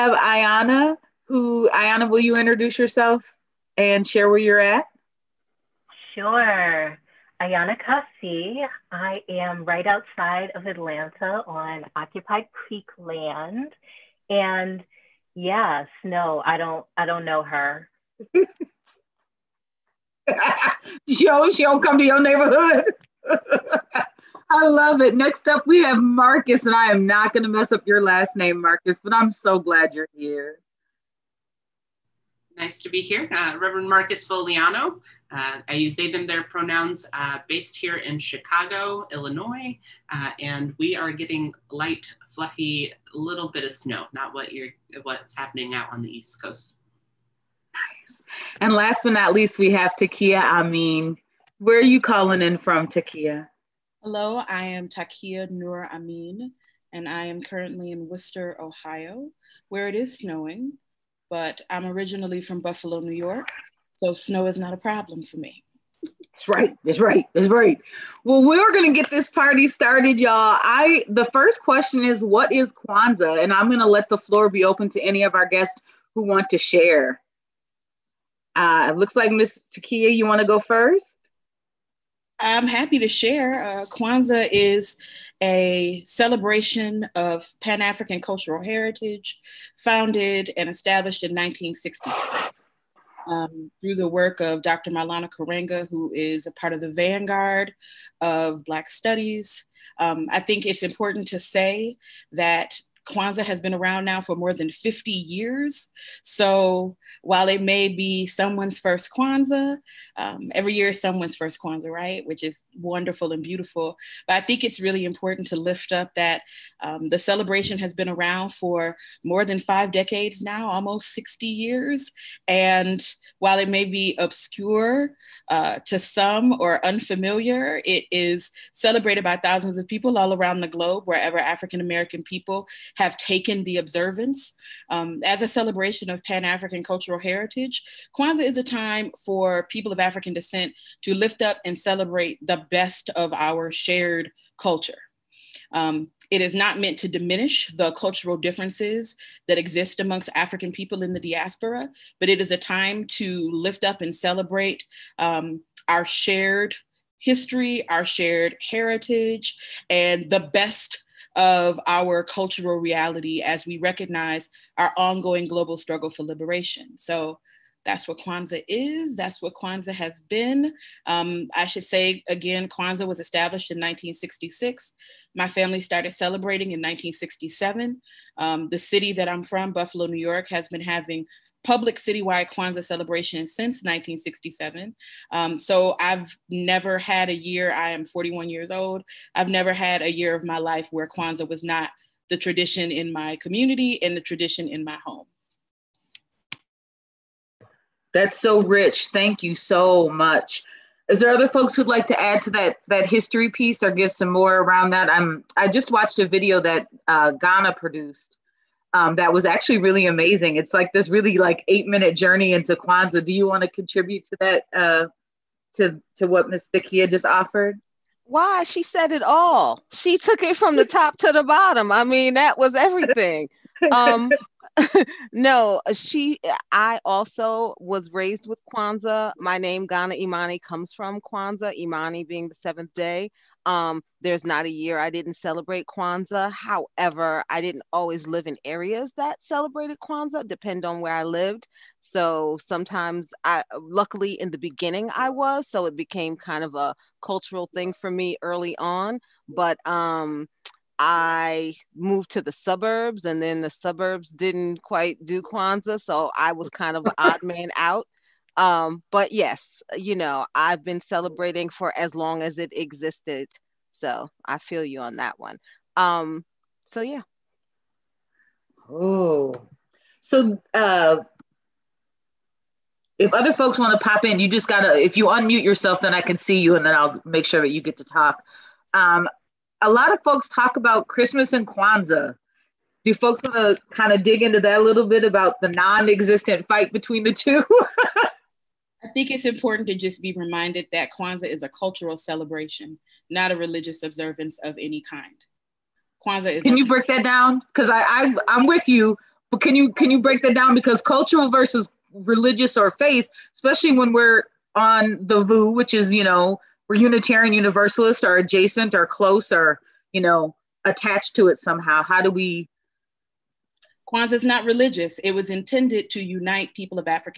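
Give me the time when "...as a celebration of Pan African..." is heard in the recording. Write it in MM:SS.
02:15.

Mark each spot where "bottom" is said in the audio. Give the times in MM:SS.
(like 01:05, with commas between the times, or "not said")
03:41.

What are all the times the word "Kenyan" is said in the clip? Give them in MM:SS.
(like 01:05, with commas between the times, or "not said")
not said.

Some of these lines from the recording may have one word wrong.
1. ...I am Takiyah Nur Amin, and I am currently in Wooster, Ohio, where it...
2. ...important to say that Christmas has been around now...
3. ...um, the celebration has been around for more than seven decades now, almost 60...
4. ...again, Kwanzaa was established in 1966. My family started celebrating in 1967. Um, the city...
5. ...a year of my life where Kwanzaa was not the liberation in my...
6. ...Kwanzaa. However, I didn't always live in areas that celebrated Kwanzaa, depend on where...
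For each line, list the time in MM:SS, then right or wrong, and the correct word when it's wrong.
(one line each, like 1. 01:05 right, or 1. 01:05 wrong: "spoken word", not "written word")
1. 00:54 right
2. 01:40 wrong: "Kwanzaa", not "Christmas"
3. 01:56 wrong: "five", not "seven"
4. 02:52 right
5. 03:10 wrong: "tradition", not "liberation"
6. 03:55 right.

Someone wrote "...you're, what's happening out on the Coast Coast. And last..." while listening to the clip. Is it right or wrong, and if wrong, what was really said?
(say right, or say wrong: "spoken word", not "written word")
wrong: "East", not "Coast".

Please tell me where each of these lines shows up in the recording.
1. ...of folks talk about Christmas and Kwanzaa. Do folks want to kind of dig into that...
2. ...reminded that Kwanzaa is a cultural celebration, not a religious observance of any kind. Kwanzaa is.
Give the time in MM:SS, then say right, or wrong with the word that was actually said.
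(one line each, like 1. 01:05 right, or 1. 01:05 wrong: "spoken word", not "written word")
1. 04:40 right
2. 04:50 right.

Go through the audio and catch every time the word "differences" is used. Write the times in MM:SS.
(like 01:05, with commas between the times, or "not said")
02:28.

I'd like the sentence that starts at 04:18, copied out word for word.
Um, but yes, you know, I've been celebrating for as long as it existed.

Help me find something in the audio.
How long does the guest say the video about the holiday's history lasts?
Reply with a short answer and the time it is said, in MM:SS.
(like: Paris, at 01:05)
8 minutes, at 03:31.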